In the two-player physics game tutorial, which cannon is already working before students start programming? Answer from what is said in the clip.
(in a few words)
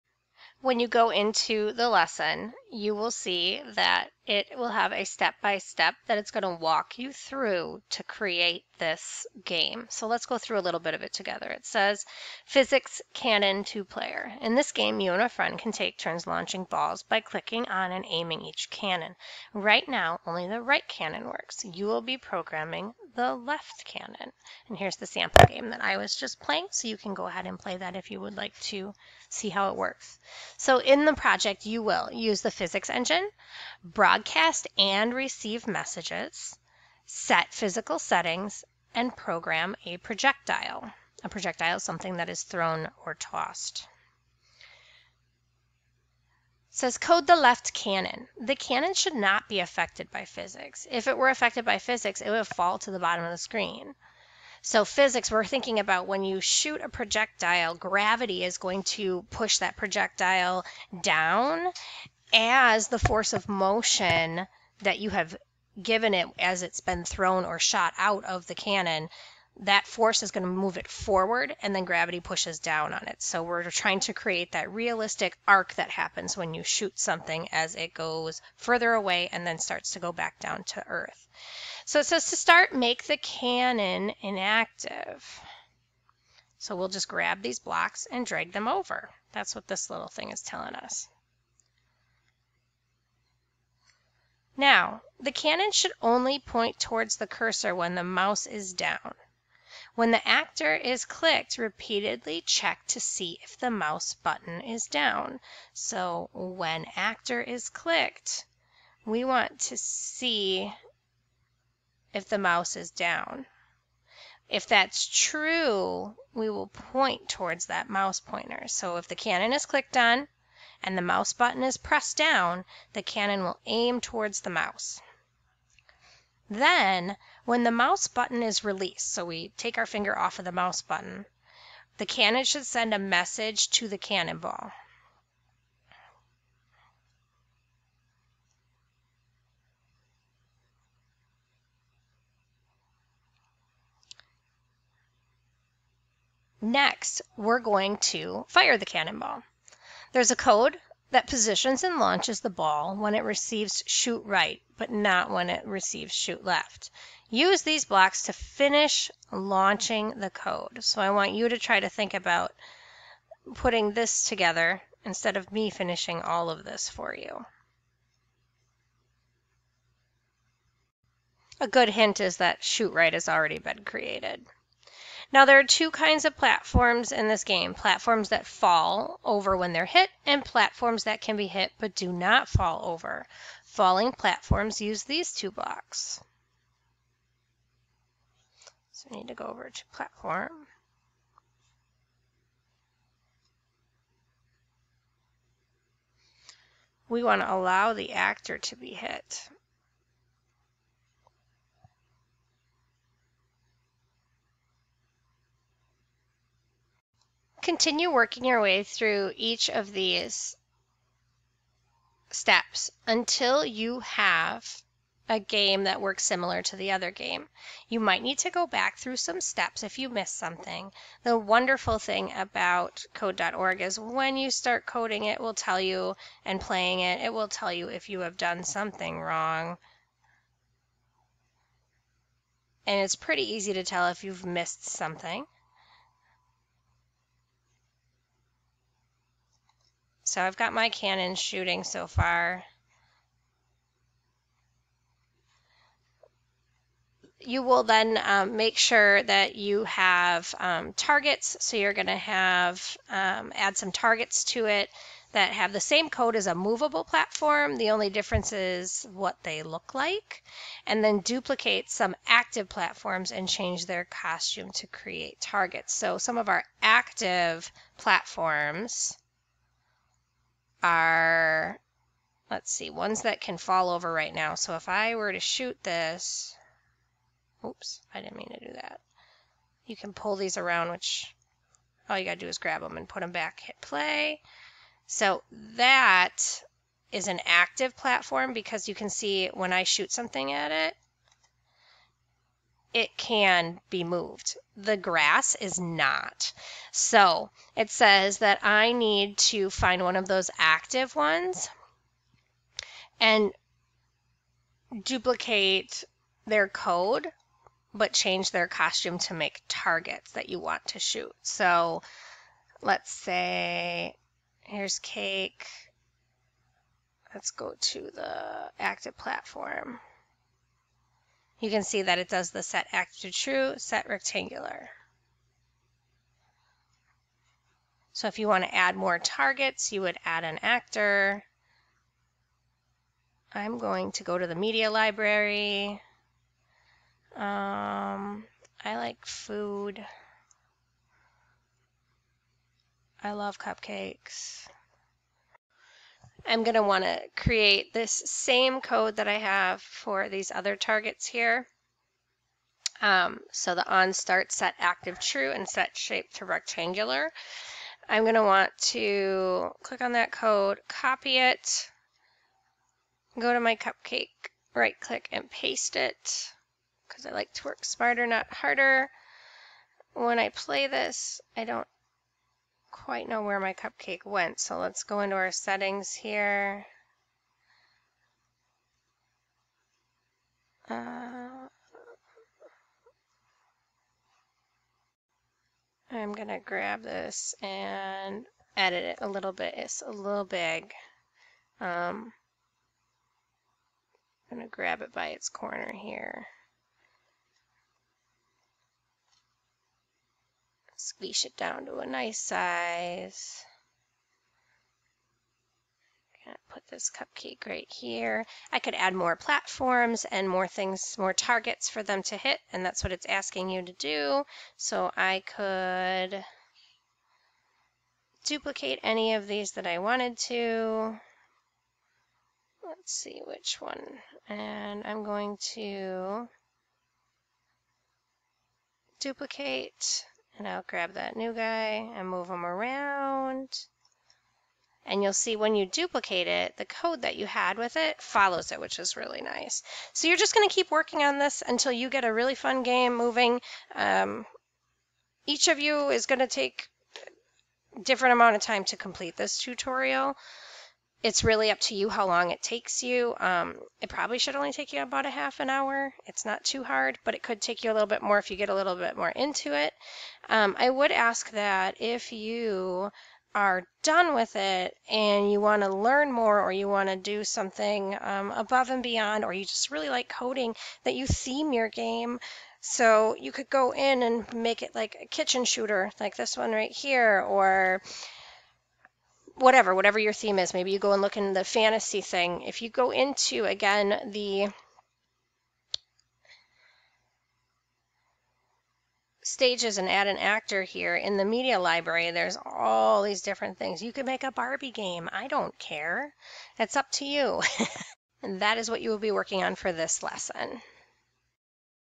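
The right cannon.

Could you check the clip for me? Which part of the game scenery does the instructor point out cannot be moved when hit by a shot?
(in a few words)
The grass.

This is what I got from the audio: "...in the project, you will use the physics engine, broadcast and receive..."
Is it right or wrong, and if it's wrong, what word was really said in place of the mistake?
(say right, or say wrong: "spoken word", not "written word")
right.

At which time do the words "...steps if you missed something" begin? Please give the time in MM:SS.
03:39.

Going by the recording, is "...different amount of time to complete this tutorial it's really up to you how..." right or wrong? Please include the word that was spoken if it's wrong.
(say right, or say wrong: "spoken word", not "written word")
right.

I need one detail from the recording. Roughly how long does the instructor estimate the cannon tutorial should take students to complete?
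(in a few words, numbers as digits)
Half an hour.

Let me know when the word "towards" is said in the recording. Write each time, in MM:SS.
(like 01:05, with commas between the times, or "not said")
01:36, 01:57, 02:03.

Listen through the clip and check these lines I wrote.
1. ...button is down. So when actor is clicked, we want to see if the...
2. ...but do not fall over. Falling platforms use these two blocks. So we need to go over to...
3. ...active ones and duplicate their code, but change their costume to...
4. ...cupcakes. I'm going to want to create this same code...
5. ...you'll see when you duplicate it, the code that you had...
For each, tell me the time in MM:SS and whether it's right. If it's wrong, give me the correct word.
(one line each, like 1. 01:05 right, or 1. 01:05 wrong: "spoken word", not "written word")
1. 01:44 right
2. 03:01 right
3. 05:00 right
4. 05:43 right
5. 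07:15 right.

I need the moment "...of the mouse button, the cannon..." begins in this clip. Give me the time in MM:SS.
02:10.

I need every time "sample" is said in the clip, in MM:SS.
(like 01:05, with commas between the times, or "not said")
00:25.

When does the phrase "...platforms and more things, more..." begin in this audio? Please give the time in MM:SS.
06:49.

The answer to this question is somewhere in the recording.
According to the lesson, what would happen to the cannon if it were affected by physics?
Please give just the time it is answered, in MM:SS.
00:52.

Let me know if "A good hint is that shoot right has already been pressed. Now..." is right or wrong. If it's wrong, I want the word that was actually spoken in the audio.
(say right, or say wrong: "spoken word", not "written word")
wrong: "created", not "pressed".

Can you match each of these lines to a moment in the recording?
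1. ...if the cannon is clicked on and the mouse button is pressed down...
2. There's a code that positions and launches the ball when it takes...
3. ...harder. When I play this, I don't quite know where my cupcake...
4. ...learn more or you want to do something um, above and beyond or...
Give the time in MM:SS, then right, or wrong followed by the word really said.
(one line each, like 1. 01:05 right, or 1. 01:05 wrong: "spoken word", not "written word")
1. 01:58 right
2. 02:30 wrong: "receives", not "takes"
3. 06:08 right
4. 07:45 right.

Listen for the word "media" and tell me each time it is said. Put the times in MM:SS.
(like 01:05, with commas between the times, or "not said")
05:34, 08:11.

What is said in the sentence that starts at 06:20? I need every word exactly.
Uh, I'm gonna grab this and edit it a little bit.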